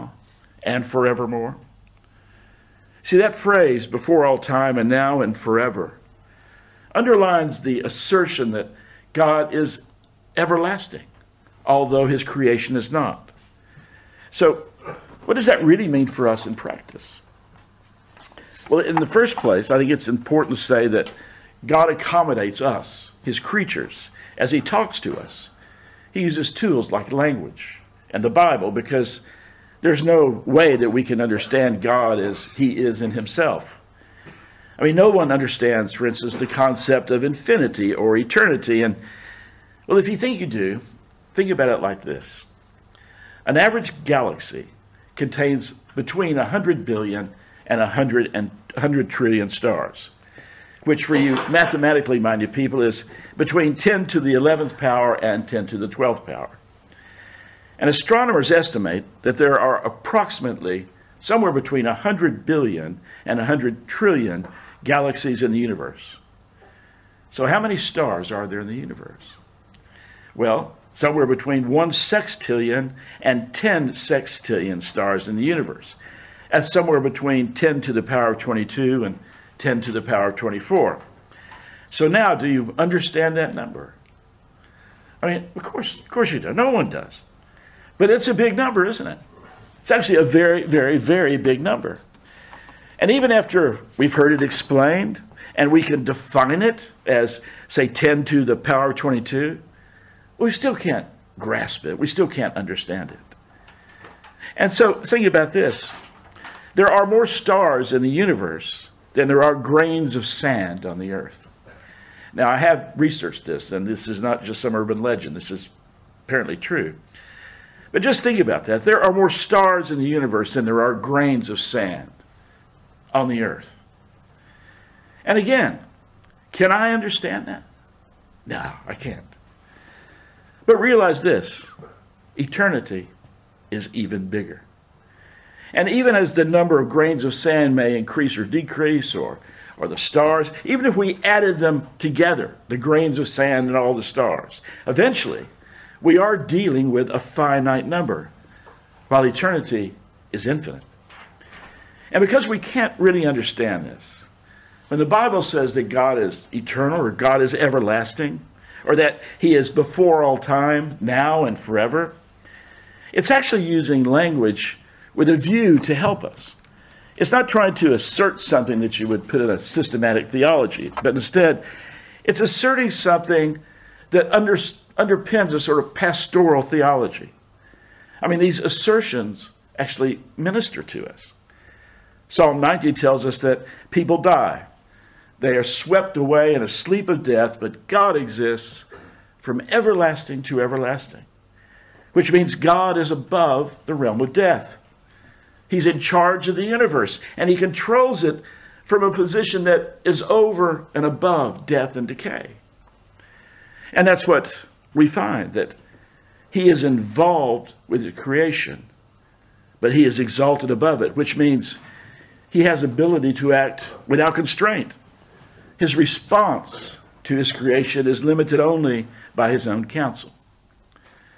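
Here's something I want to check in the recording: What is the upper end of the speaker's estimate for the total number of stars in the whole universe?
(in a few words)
10 sextillion.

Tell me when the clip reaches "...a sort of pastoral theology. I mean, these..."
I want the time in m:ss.
2:55.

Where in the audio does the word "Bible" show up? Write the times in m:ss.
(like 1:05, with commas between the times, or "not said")
0:28, 2:35.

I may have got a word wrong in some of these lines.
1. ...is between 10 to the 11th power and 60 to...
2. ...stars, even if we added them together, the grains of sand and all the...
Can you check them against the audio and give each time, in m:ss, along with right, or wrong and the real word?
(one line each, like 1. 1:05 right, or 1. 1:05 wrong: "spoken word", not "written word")
1. 0:52 wrong: "10", not "60"
2. 2:19 right.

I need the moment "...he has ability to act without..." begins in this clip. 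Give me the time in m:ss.
3:32.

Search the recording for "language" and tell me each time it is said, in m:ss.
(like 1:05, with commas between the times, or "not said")
0:27, 2:44.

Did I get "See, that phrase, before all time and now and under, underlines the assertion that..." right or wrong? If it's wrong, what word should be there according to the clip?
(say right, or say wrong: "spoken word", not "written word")
wrong: "forever", not "under".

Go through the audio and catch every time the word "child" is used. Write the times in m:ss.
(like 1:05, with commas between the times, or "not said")
not said.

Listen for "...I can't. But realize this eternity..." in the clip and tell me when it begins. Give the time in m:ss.
2:08.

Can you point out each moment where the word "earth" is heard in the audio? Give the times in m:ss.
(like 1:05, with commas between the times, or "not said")
1:51, 2:03.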